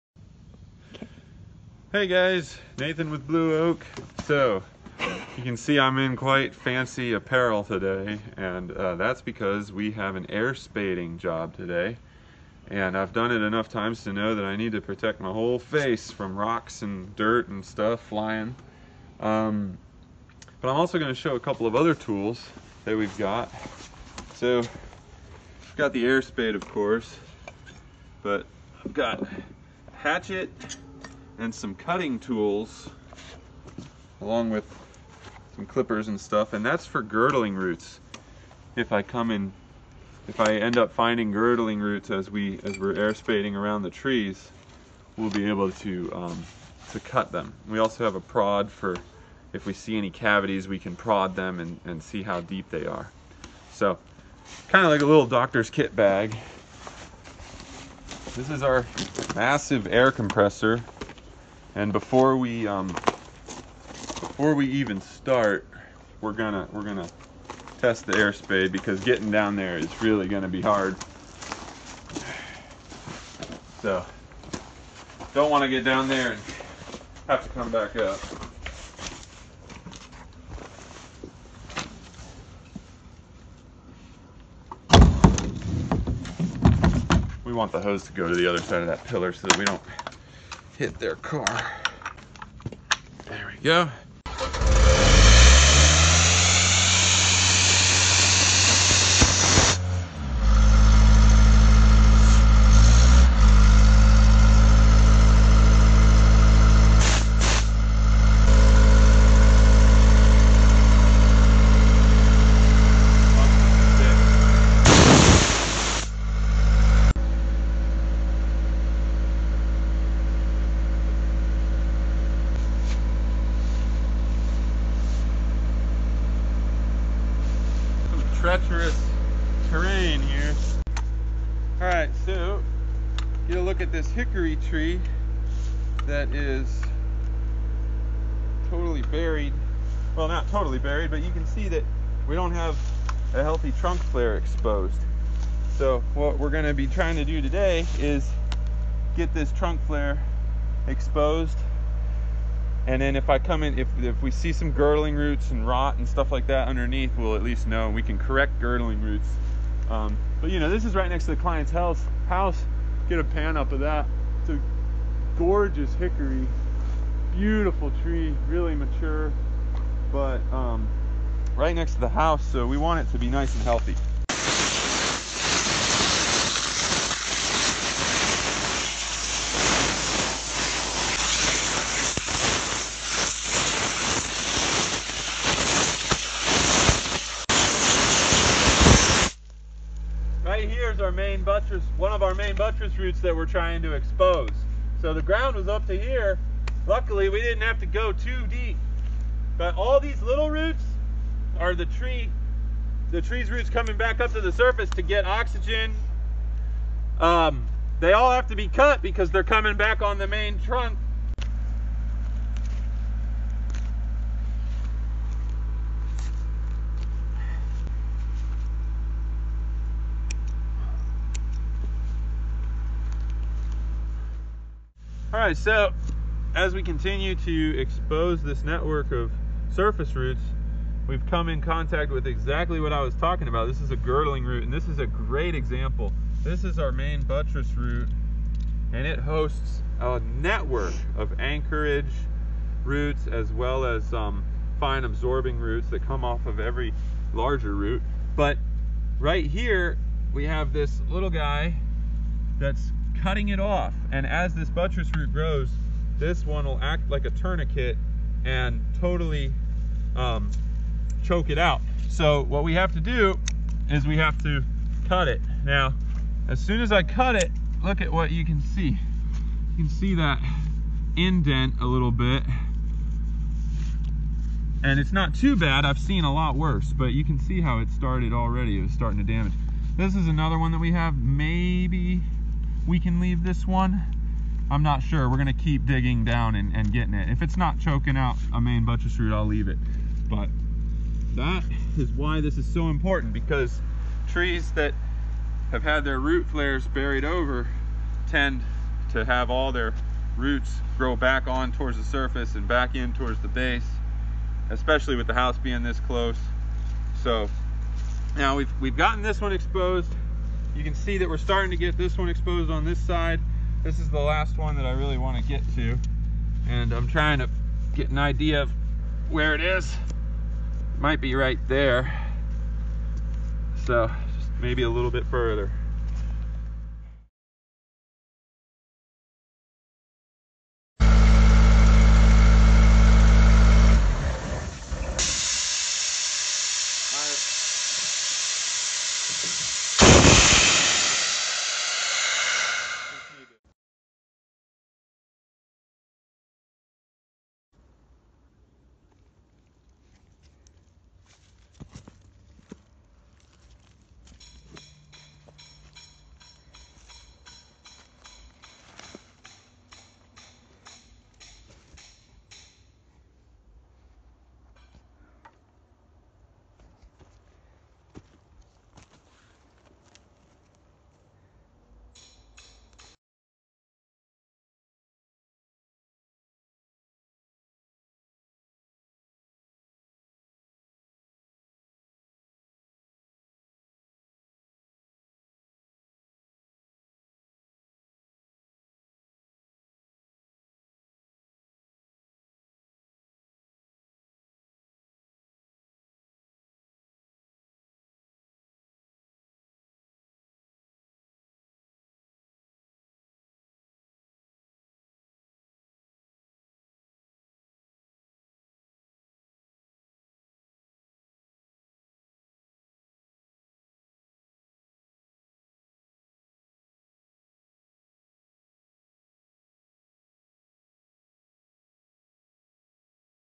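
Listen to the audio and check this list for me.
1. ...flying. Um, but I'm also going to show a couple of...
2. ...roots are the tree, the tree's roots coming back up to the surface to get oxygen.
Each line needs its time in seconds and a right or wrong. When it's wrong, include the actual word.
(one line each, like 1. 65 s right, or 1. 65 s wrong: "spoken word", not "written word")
1. 17 s right
2. 200 s right.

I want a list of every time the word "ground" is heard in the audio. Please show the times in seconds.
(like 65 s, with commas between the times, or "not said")
195 s.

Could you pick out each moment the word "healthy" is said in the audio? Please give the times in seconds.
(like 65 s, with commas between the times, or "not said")
143 s, 173 s.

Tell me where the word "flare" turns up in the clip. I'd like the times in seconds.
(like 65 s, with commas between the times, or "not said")
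144 s, 149 s, 296 s.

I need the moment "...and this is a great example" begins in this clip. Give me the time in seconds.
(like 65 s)
234 s.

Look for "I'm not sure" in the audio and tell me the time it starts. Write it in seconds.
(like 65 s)
284 s.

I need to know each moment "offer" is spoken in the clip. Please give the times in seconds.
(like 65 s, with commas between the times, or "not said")
not said.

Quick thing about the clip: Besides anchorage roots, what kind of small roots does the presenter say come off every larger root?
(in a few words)
Fine absorbing roots.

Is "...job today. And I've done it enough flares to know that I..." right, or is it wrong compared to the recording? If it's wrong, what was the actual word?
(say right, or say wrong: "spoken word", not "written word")
wrong: "times", not "flares".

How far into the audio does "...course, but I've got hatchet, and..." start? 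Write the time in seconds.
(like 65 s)
26 s.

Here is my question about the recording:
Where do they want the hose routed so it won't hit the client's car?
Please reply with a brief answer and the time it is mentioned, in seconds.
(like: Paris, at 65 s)
Other side of that pillar, at 88 s.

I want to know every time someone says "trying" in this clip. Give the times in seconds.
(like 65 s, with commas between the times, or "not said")
146 s, 193 s, 317 s.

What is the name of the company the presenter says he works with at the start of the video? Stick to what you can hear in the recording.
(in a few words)
Blue Oak.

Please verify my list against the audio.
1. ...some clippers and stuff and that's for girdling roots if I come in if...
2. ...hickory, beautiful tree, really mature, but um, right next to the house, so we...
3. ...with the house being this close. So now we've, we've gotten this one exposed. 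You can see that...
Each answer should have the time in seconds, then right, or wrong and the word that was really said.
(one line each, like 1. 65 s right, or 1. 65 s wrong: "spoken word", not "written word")
1. 35 s right
2. 165 s right
3. 305 s right.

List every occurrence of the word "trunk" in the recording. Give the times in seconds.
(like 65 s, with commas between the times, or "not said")
143 s, 149 s, 210 s.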